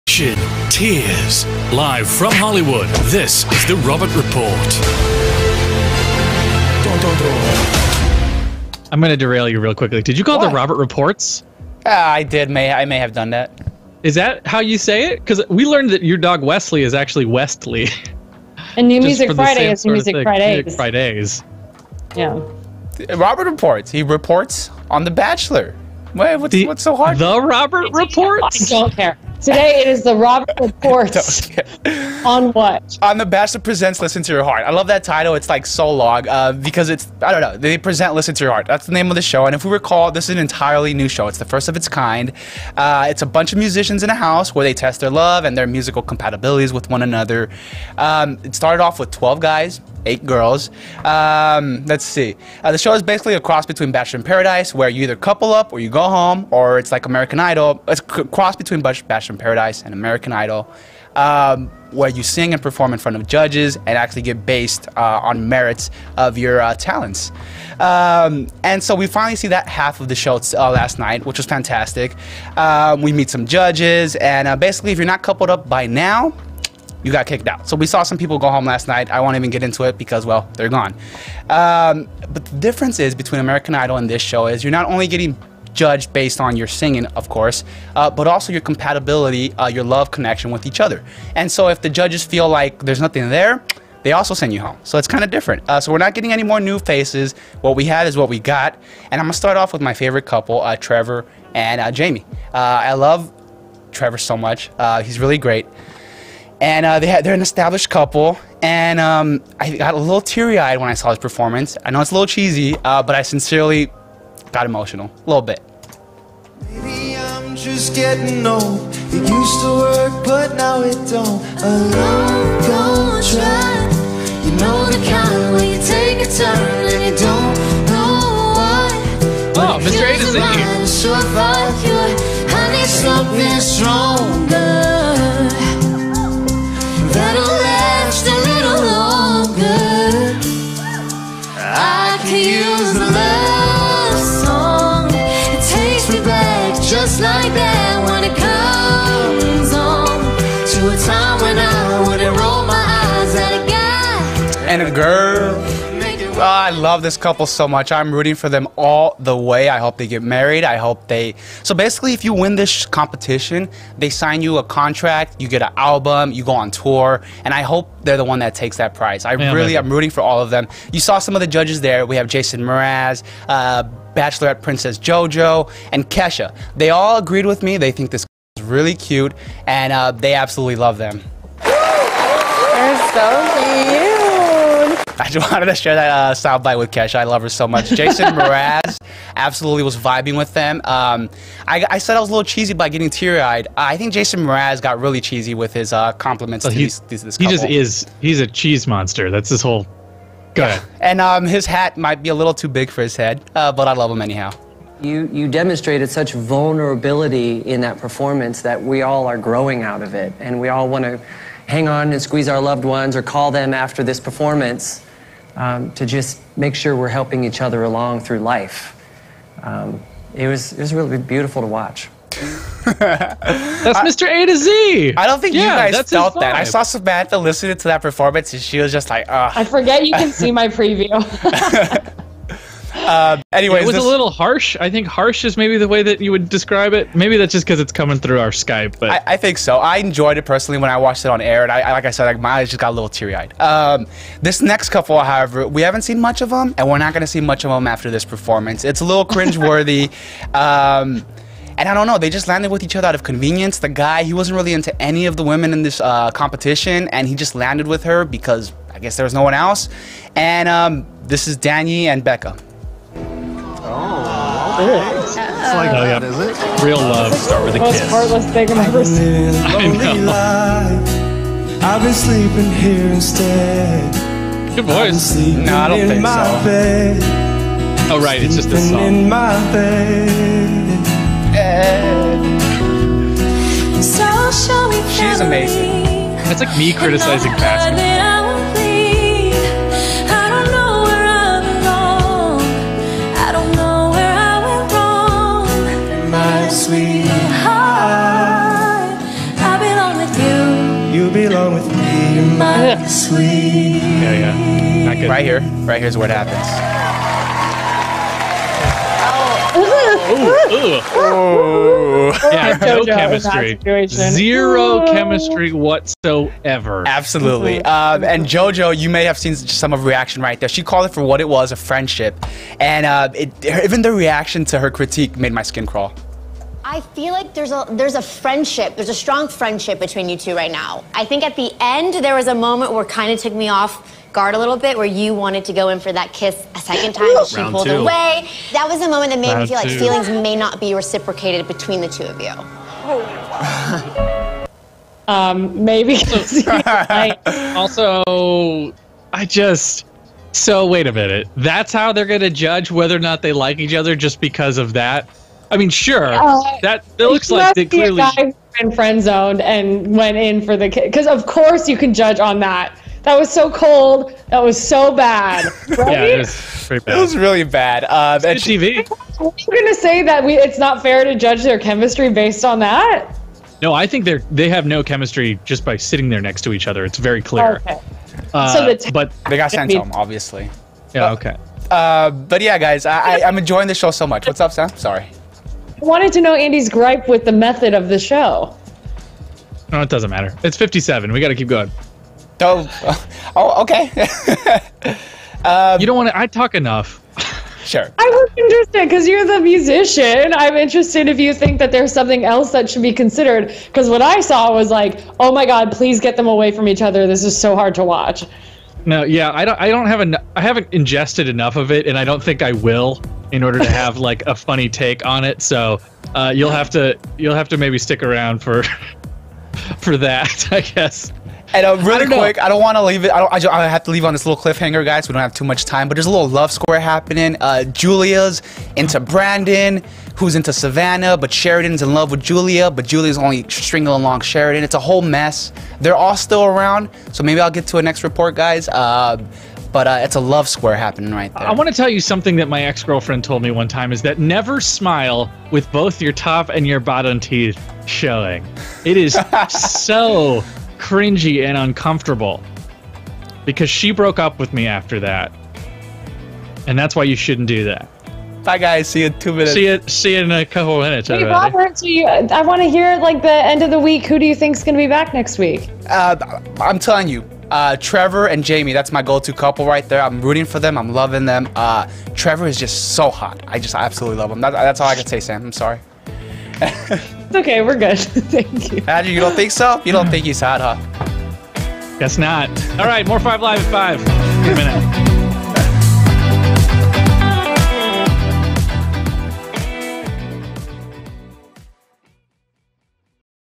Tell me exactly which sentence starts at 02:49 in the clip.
I yeah, really, I'm rooting for all of them.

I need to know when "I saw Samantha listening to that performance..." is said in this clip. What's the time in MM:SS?
03:46.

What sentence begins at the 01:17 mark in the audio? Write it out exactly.
So we saw some people go home last night.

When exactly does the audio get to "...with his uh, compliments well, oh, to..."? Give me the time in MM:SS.
03:15.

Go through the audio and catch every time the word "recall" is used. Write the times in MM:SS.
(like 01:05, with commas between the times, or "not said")
00:39.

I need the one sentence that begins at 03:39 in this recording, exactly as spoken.
Um, it was it was really beautiful to watch.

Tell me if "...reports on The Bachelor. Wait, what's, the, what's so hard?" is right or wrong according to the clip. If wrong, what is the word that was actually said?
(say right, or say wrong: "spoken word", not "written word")
right.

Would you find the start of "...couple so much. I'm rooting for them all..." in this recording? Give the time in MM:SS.
02:37.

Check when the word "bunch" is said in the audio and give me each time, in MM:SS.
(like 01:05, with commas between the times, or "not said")
00:43.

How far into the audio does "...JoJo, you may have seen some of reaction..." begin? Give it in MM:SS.
05:18.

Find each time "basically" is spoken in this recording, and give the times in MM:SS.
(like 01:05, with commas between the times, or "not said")
00:53, 01:14, 02:41.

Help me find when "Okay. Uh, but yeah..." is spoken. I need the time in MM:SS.
06:21.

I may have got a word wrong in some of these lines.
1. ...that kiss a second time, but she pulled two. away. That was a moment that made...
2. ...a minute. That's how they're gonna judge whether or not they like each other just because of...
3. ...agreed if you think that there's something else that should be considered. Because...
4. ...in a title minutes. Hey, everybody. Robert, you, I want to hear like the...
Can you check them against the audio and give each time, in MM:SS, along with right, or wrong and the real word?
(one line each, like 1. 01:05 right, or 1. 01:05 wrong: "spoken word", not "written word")
1. 05:36 right
2. 05:51 right
3. 06:40 wrong: "interested", not "agreed"
4. 07:40 wrong: "couple", not "title".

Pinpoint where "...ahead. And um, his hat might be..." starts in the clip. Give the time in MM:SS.
03:20.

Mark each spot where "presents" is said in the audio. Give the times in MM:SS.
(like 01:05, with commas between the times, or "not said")
00:33, 00:37.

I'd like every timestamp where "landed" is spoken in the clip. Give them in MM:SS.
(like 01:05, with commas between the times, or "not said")
04:12, 04:17.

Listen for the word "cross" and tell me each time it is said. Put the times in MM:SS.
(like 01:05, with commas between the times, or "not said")
00:53, 00:58.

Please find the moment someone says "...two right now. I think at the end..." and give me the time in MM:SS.
05:30.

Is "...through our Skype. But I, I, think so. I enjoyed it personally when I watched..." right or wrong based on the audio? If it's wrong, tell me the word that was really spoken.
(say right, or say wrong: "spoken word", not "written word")
right.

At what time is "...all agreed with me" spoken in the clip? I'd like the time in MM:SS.
02:56.